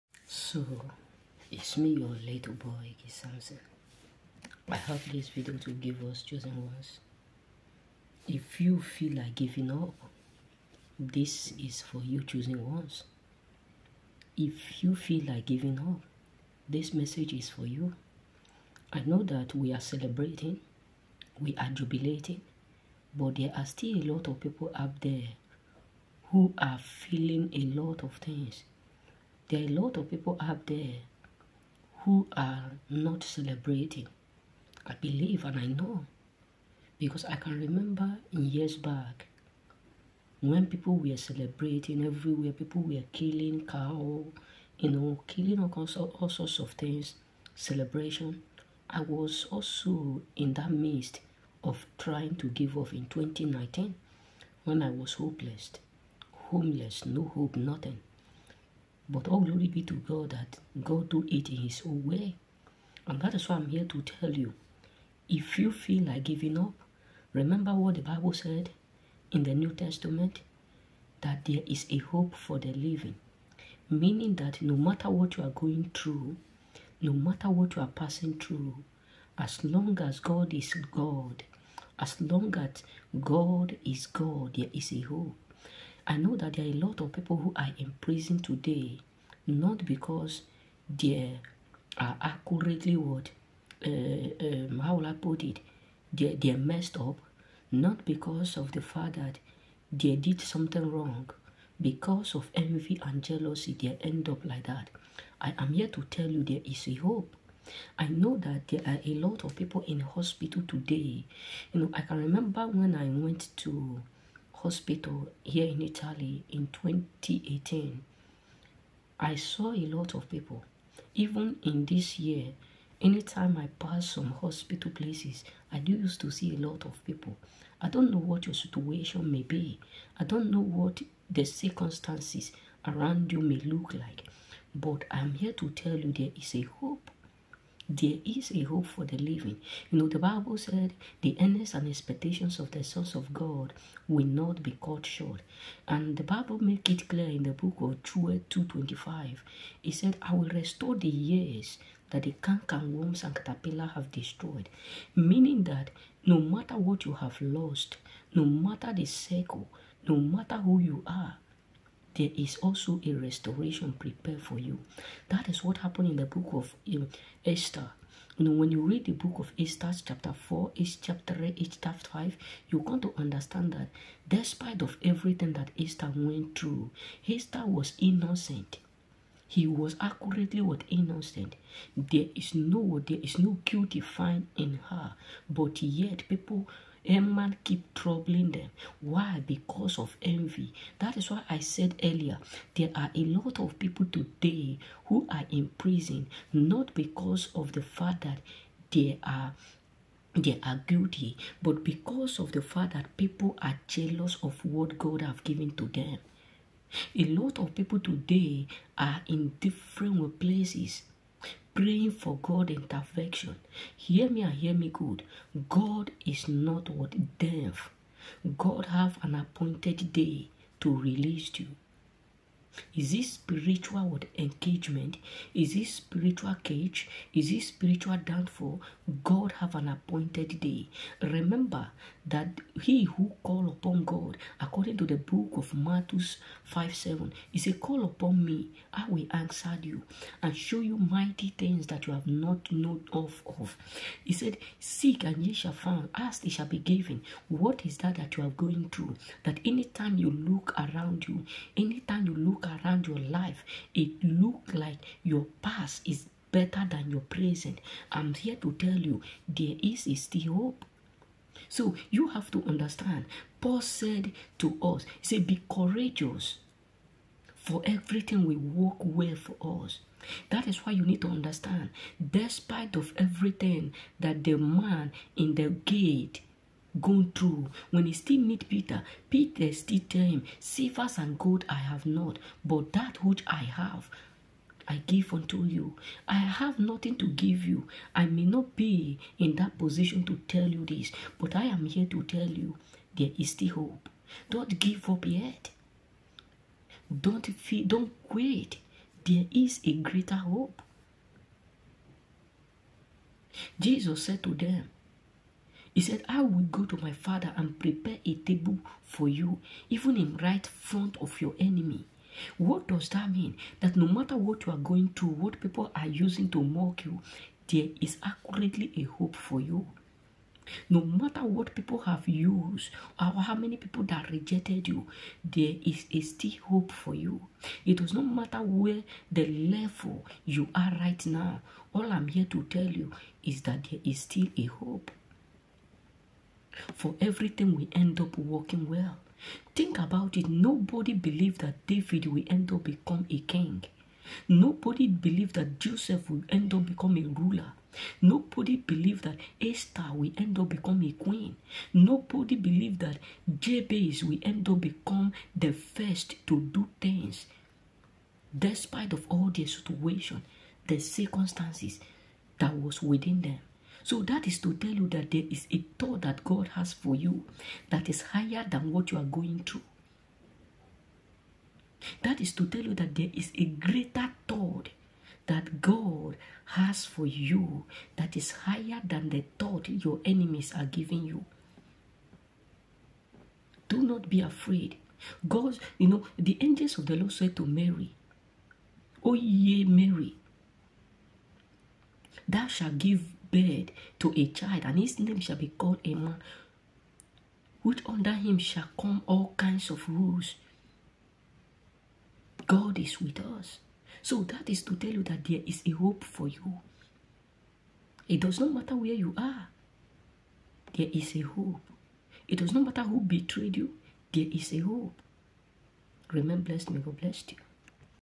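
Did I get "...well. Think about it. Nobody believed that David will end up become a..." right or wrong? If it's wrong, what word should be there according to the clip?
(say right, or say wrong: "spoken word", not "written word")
right.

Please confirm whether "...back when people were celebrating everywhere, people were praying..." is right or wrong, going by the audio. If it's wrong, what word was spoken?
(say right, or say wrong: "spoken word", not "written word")
wrong: "killing", not "praying".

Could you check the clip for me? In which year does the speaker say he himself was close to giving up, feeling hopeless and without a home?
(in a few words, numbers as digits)
2019.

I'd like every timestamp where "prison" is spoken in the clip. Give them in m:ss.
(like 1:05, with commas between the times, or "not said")
1:28, 3:15.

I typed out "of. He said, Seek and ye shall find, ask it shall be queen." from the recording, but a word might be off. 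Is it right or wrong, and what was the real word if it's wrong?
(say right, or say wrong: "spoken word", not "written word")
wrong: "given", not "queen".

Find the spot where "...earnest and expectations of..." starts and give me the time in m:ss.
2:21.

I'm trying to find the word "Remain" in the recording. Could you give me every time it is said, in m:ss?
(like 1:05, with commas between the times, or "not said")
6:56.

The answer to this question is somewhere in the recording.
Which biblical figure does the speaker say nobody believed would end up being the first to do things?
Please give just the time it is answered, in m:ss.
5:53.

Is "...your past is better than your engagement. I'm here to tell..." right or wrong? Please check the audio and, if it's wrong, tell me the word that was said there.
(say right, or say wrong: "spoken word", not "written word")
wrong: "present", not "engagement".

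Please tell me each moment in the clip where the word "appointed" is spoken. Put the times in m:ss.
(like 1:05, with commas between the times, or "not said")
3:39, 3:49.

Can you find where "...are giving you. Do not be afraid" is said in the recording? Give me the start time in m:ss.
6:20.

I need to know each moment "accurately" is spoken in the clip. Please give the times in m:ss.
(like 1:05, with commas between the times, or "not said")
1:32, 2:59, 5:18.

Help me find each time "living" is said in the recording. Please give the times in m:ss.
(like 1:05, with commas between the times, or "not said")
1:12, 2:19.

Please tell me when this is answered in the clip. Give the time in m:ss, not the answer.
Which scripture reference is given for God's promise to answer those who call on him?
3:55.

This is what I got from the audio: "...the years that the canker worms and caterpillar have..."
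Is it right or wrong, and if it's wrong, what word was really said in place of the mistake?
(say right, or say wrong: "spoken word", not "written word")
right.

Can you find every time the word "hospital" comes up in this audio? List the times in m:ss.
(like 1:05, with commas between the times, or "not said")
1:49, 1:54, 2:04.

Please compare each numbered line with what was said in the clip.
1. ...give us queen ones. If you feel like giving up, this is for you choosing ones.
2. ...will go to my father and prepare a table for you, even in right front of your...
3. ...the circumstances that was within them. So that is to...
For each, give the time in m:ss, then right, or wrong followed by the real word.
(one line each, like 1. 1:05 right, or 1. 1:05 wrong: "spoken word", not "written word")
1. 0:05 wrong: "chosen", not "queen"
2. 5:06 right
3. 6:00 right.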